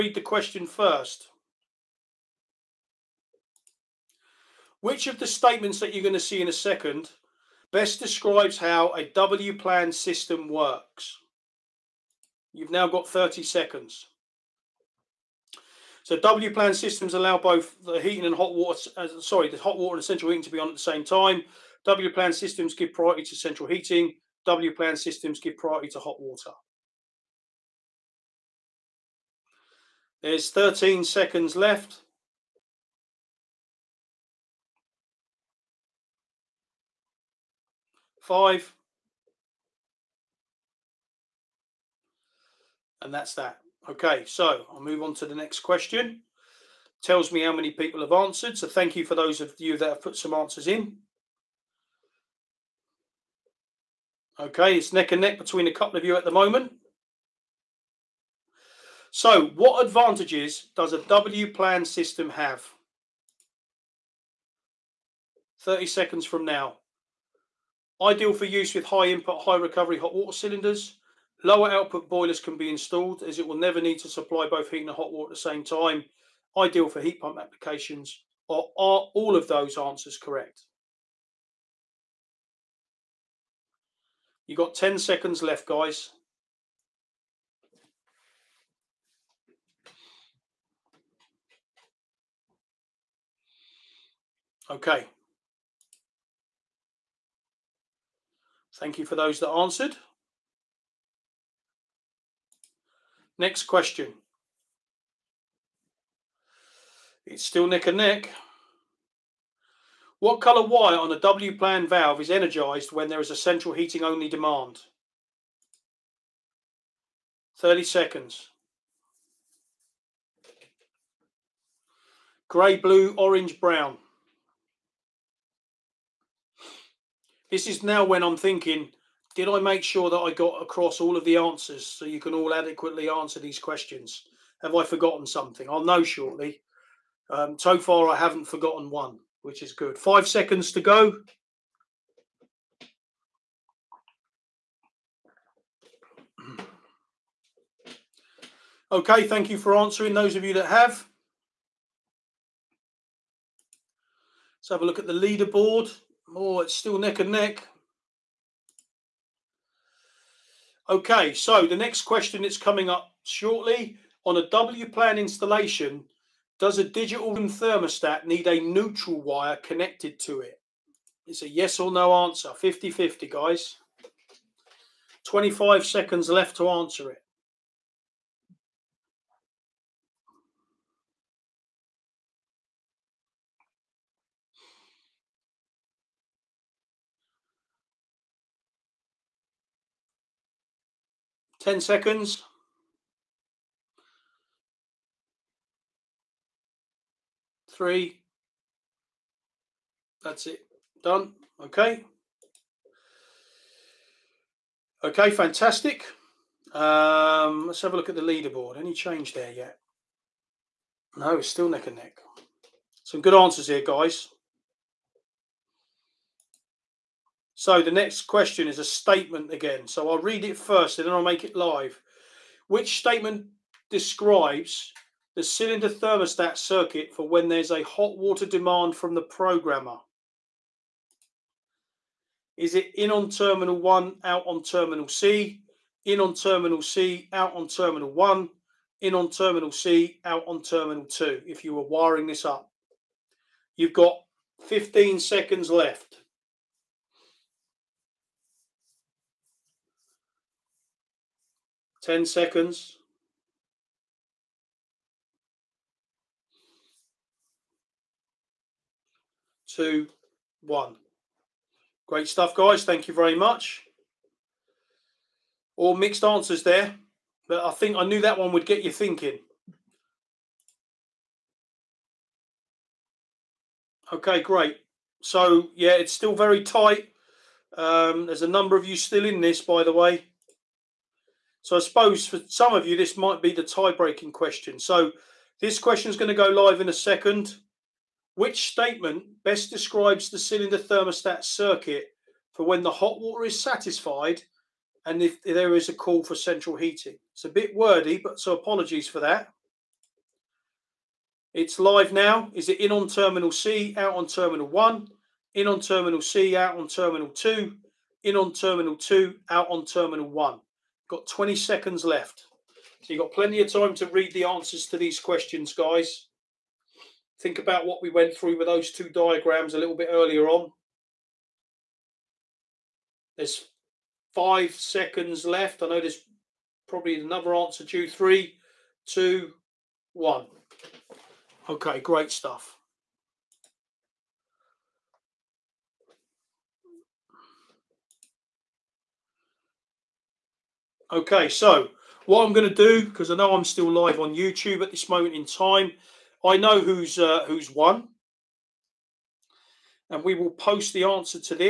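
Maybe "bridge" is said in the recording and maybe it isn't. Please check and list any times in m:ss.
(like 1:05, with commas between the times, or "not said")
not said.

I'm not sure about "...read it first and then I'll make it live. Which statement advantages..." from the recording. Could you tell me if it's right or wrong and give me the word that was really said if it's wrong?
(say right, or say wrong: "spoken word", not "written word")
wrong: "describes", not "advantages".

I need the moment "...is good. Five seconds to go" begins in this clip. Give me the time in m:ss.
2:19.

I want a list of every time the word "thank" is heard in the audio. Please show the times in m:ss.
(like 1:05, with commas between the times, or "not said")
0:48, 1:38, 2:29, 4:22.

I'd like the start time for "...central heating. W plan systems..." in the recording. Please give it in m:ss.
0:23.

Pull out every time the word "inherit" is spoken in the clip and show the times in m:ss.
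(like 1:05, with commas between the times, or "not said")
not said.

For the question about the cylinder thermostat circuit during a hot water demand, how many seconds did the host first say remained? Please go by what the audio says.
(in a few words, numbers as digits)
15.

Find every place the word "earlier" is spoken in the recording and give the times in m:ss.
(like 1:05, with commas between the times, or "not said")
5:20.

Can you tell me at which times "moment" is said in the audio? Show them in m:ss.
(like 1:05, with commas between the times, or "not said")
0:56, 5:45.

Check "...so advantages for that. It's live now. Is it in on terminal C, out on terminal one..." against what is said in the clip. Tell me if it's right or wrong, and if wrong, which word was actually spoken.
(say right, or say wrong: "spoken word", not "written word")
wrong: "apologies", not "advantages".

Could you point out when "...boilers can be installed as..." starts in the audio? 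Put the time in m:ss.
1:12.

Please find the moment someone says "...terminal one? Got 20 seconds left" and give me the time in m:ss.
5:09.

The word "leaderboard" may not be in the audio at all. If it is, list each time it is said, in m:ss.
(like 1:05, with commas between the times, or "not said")
2:35, 3:28.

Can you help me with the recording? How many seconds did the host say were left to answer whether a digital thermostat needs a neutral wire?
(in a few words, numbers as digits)
25.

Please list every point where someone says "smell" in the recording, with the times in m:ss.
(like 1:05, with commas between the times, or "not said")
not said.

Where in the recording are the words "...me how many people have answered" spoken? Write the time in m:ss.
0:47.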